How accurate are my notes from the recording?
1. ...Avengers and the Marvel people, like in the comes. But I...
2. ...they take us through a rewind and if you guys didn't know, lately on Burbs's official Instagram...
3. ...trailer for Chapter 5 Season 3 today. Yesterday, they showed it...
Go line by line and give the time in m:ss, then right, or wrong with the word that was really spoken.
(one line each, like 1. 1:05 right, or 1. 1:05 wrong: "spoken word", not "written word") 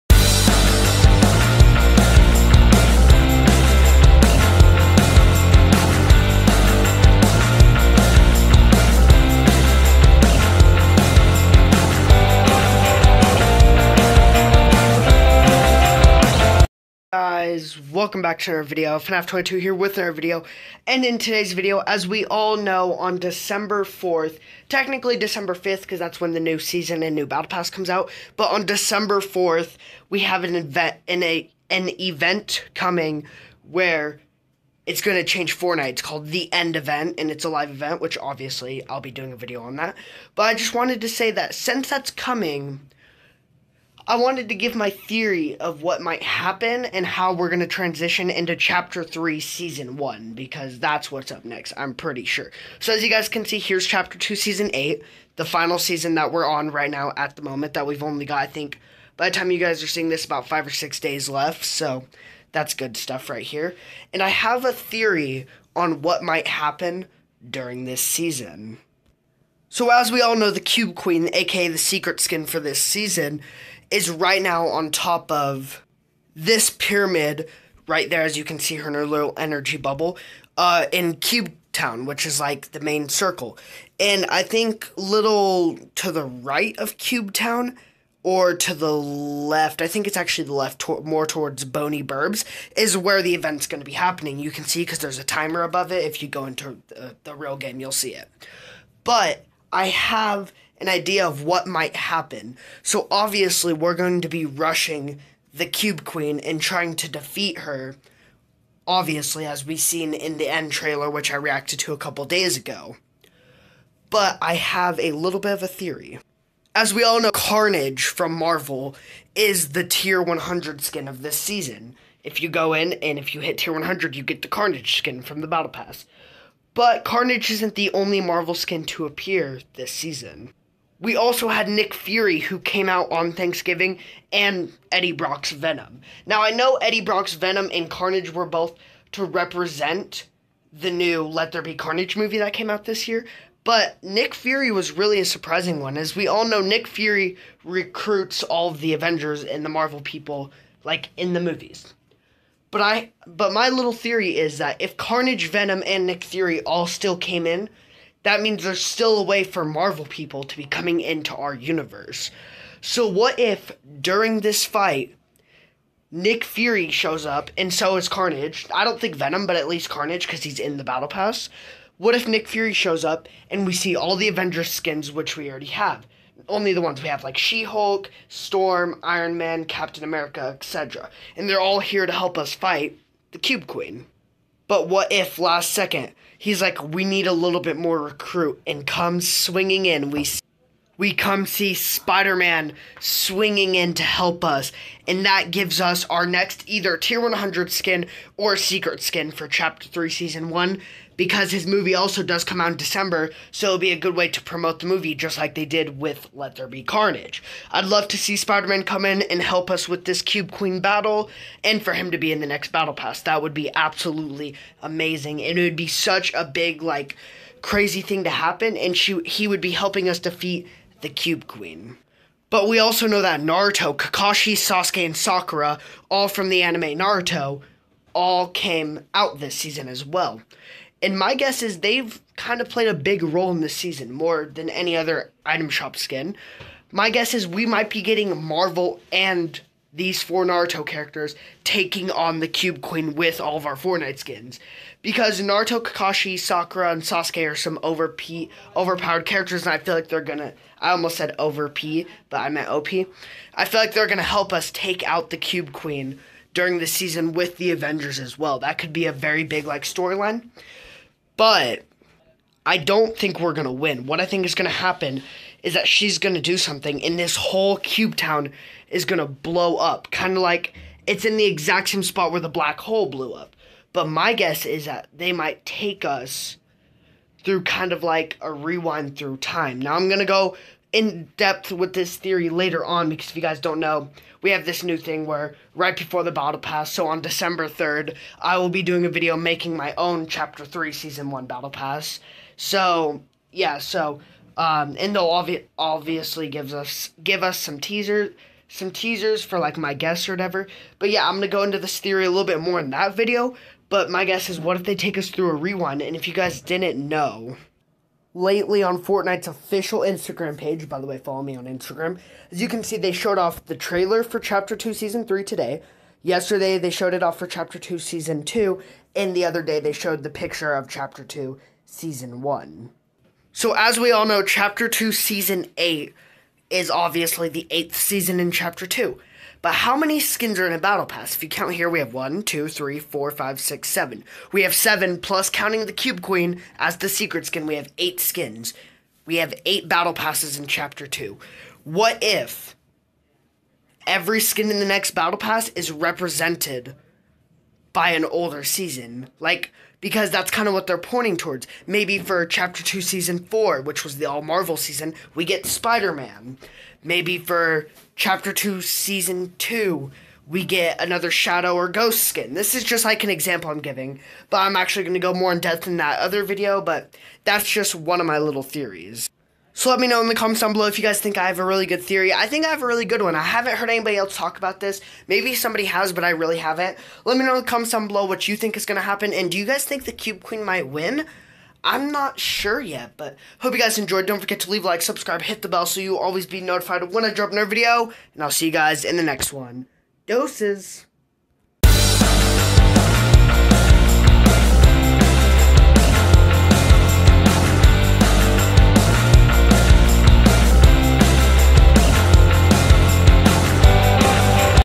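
1. 2:28 wrong: "movies", not "comes"
2. 5:04 wrong: "Fortnite", not "Burbs"
3. 5:13 wrong: "2", not "5".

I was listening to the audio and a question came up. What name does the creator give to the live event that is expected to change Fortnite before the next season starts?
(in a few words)
The End Event.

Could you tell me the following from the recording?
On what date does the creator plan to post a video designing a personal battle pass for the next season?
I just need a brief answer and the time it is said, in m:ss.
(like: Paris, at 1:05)
December 3rd, at 4:47.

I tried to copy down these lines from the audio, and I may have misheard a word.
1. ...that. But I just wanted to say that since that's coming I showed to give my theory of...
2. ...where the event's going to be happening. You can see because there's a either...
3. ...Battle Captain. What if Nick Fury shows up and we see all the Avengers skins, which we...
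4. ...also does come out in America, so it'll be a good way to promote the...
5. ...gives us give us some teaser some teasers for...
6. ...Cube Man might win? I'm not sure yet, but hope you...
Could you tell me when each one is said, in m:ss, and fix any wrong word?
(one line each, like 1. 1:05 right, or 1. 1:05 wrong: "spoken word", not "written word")
1. 0:39 wrong: "wanted", not "showed"
2. 1:32 wrong: "timer", not "either"
3. 2:50 wrong: "Pass", not "Captain"
4. 3:21 wrong: "December", not "America"
5. 4:56 right
6. 6:20 wrong: "Queen", not "Man".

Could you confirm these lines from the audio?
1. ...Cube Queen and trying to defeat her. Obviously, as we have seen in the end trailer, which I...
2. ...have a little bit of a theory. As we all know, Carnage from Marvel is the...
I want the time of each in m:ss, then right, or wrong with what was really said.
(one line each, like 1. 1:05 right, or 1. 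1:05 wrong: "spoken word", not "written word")
1. 1:45 right
2. 1:54 right.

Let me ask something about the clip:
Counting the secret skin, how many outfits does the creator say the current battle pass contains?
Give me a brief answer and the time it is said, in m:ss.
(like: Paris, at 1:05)
8, at 5:37.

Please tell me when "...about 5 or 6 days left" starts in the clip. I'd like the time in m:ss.
1:00.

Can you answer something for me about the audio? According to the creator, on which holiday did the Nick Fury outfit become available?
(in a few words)
Thanksgiving.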